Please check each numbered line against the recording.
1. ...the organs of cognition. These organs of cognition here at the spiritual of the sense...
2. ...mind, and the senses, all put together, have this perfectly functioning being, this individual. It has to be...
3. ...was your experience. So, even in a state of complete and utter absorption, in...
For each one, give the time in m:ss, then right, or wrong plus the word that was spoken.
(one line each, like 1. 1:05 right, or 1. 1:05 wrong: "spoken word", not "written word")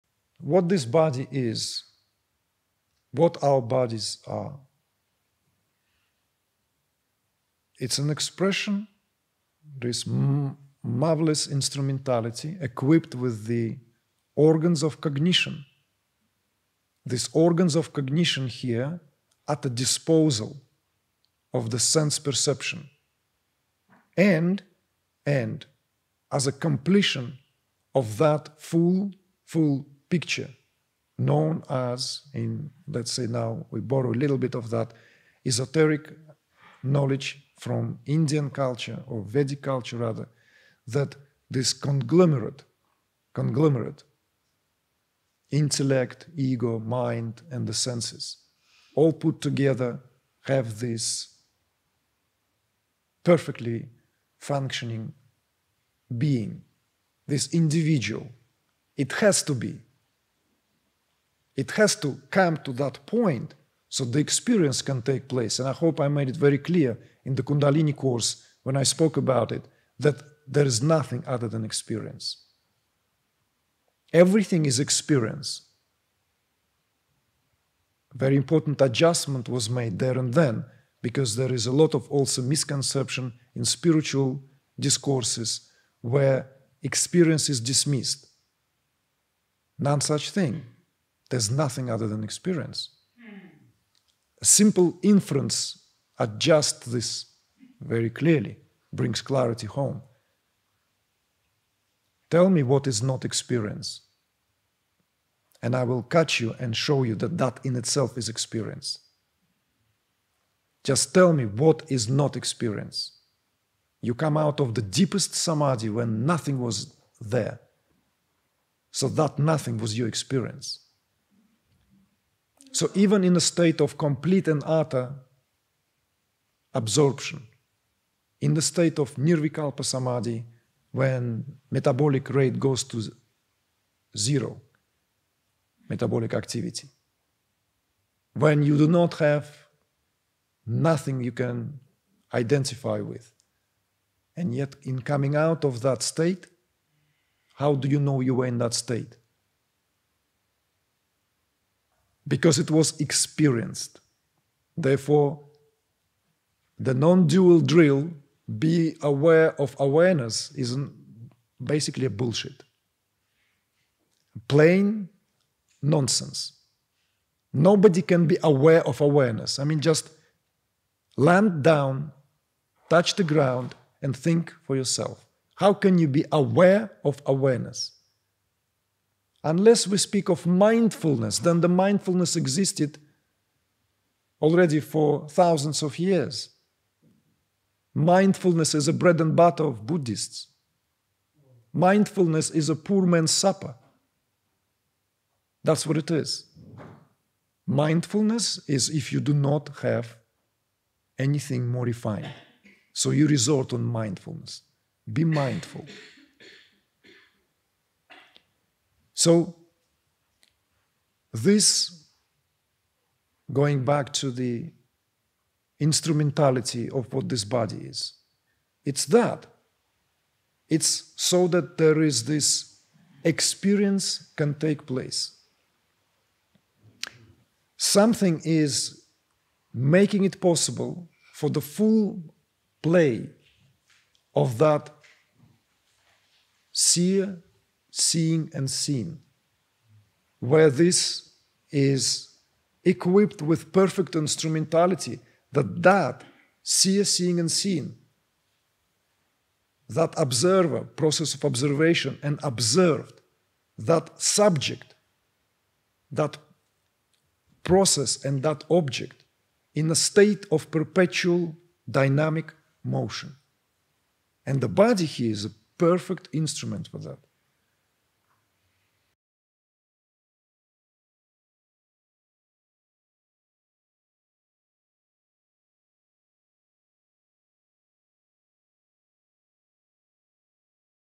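1. 0:13 wrong: "disposal", not "spiritual"
2. 0:46 right
3. 1:59 right.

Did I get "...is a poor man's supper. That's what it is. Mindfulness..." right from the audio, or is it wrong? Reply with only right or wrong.
right.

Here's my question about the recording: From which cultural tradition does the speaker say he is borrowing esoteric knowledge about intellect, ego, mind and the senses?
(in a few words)
Vedic culture.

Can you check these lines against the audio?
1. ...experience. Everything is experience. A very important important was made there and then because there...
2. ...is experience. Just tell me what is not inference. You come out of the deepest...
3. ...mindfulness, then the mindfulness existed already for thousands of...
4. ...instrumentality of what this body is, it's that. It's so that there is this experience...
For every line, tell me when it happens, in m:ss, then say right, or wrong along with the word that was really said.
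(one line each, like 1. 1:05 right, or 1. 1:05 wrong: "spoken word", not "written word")
1. 1:11 wrong: "adjustment", not "important"
2. 1:48 wrong: "experience", not "inference"
3. 3:00 right
4. 3:35 right.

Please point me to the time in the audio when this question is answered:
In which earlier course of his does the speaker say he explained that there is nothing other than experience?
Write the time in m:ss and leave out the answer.
1:07.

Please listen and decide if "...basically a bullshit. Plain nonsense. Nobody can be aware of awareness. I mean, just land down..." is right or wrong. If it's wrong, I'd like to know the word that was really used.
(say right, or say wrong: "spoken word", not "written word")
right.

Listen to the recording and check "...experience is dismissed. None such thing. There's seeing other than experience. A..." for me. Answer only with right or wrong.
wrong.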